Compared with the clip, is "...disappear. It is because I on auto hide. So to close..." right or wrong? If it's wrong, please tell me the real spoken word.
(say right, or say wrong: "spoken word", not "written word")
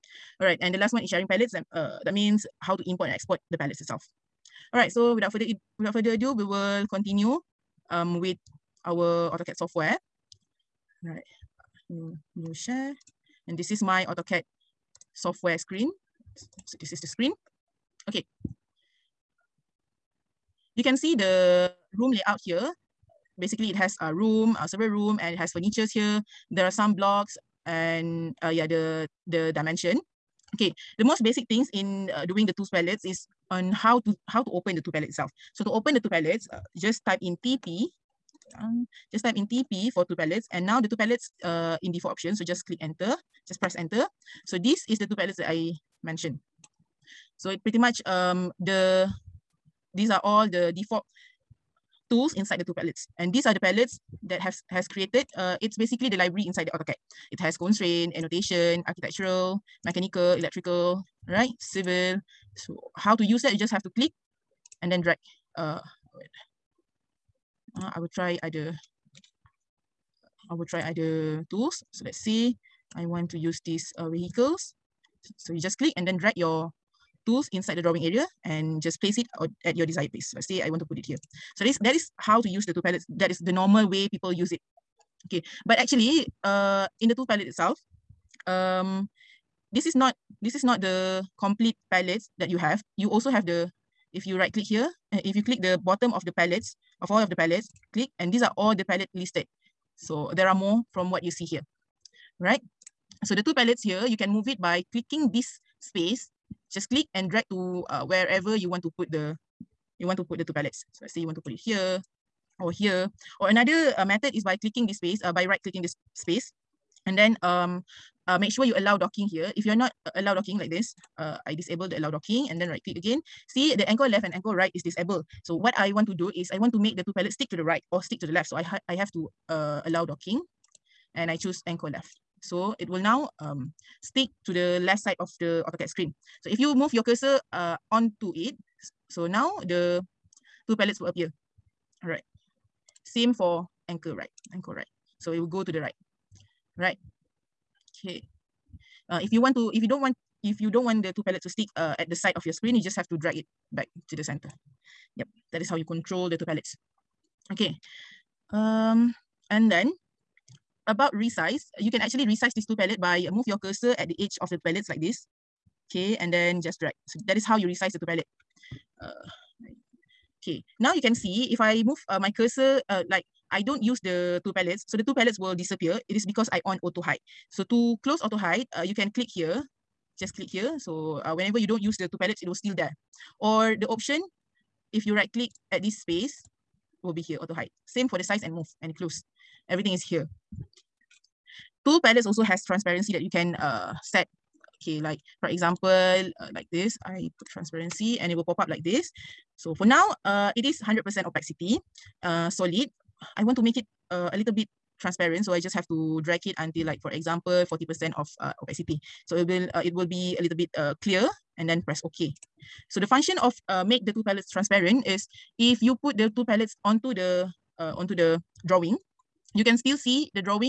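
right.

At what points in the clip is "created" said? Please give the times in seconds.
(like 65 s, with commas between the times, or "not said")
54 s.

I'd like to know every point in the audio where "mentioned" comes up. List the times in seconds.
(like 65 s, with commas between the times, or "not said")
46 s.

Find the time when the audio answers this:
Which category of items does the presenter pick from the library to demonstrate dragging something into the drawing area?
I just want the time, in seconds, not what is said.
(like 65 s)
74 s.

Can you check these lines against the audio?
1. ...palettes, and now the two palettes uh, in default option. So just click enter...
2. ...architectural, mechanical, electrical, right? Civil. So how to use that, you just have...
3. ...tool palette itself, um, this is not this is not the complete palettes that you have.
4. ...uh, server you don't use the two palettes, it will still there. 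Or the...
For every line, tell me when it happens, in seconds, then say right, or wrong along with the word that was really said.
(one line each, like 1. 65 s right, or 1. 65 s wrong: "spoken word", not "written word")
1. 40 s right
2. 58 s right
3. 87 s right
4. 181 s wrong: "whenever", not "server".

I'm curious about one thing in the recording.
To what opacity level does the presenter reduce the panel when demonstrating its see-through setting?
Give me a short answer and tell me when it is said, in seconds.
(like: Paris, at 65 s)
40 percent, at 207 s.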